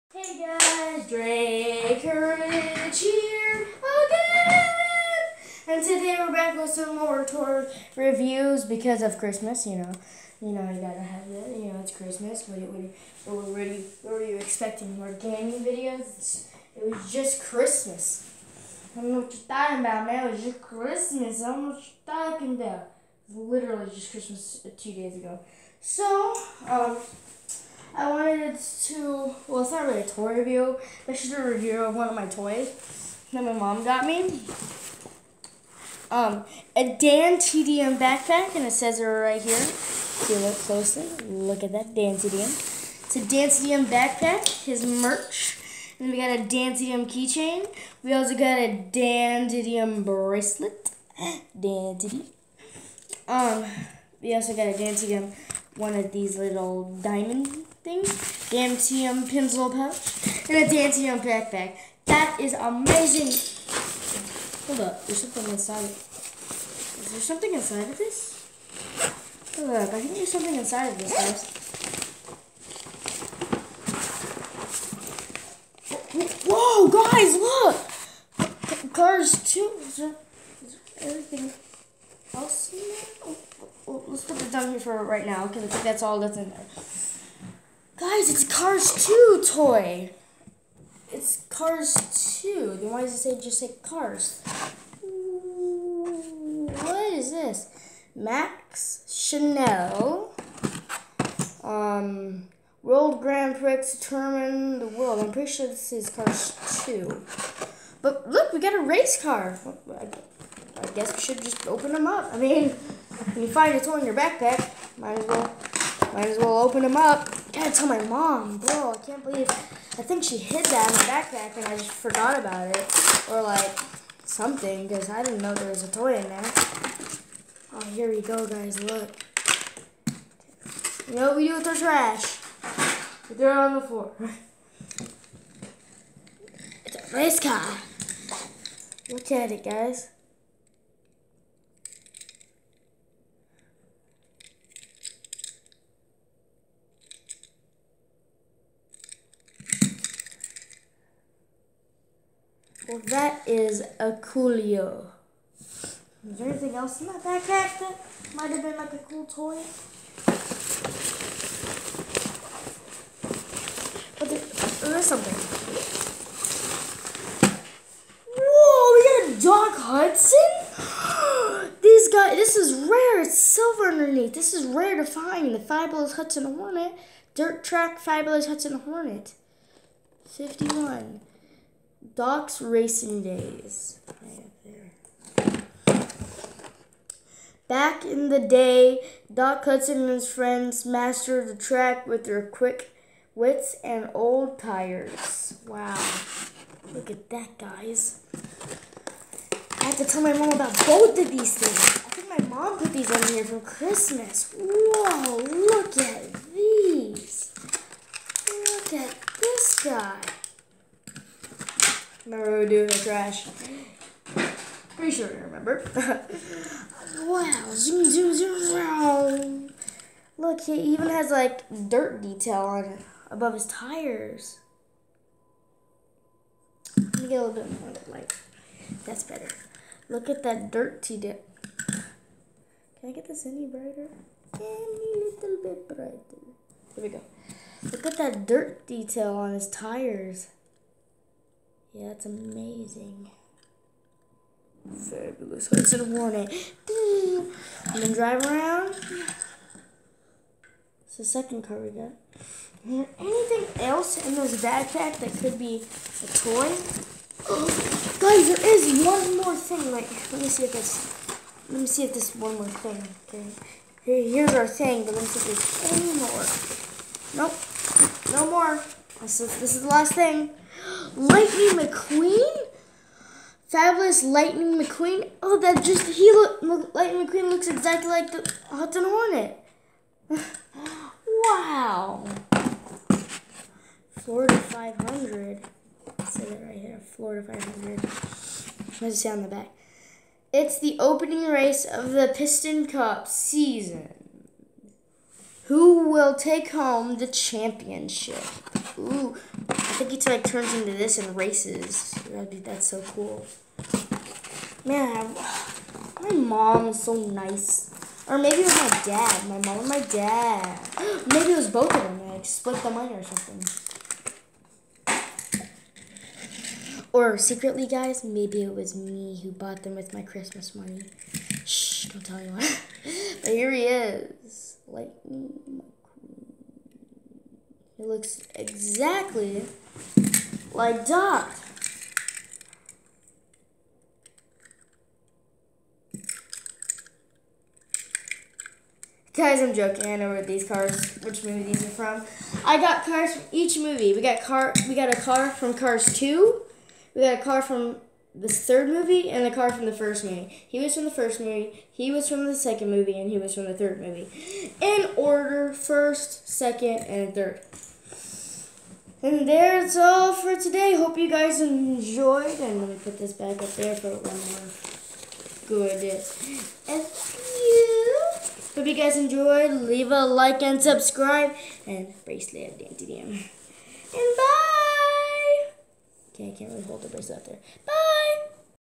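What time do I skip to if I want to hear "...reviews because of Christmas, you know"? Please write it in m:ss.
0:07.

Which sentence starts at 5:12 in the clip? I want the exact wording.
I like, split the money or something.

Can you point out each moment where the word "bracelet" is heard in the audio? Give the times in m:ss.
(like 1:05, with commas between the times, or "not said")
0:50, 6:12, 6:17.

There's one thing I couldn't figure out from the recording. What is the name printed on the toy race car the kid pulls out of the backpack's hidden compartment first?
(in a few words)
Max Schnell.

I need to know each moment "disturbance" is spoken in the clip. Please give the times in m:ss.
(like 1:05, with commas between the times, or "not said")
not said.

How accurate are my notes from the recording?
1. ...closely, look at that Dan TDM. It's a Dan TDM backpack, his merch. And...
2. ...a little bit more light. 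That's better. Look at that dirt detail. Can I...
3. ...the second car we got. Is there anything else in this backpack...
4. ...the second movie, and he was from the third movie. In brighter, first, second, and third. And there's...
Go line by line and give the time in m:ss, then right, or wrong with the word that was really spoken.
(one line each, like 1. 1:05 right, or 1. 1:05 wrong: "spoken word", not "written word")
1. 0:40 right
2. 3:47 right
3. 4:11 right
4. 5:52 wrong: "order", not "brighter".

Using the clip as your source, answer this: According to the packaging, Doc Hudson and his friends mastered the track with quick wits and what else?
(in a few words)
old tires.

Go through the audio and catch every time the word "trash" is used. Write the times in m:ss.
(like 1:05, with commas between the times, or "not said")
2:11, 3:32.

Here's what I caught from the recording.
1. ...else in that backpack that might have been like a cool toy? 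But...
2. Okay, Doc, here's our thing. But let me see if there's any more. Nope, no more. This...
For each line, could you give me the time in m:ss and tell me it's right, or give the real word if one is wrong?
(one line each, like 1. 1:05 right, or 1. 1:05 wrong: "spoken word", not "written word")
1. 2:36 right
2. 4:23 wrong: "Here", not "Doc".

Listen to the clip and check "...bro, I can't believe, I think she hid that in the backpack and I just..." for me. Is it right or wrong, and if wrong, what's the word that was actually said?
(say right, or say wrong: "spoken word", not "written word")
right.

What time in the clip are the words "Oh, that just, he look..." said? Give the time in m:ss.
4:35.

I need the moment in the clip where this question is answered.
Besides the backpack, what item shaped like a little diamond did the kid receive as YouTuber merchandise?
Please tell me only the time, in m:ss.
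0:58.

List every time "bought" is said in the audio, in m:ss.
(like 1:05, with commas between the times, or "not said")
5:19.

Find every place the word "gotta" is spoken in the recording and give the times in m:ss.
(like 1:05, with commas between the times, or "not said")
0:10, 1:57.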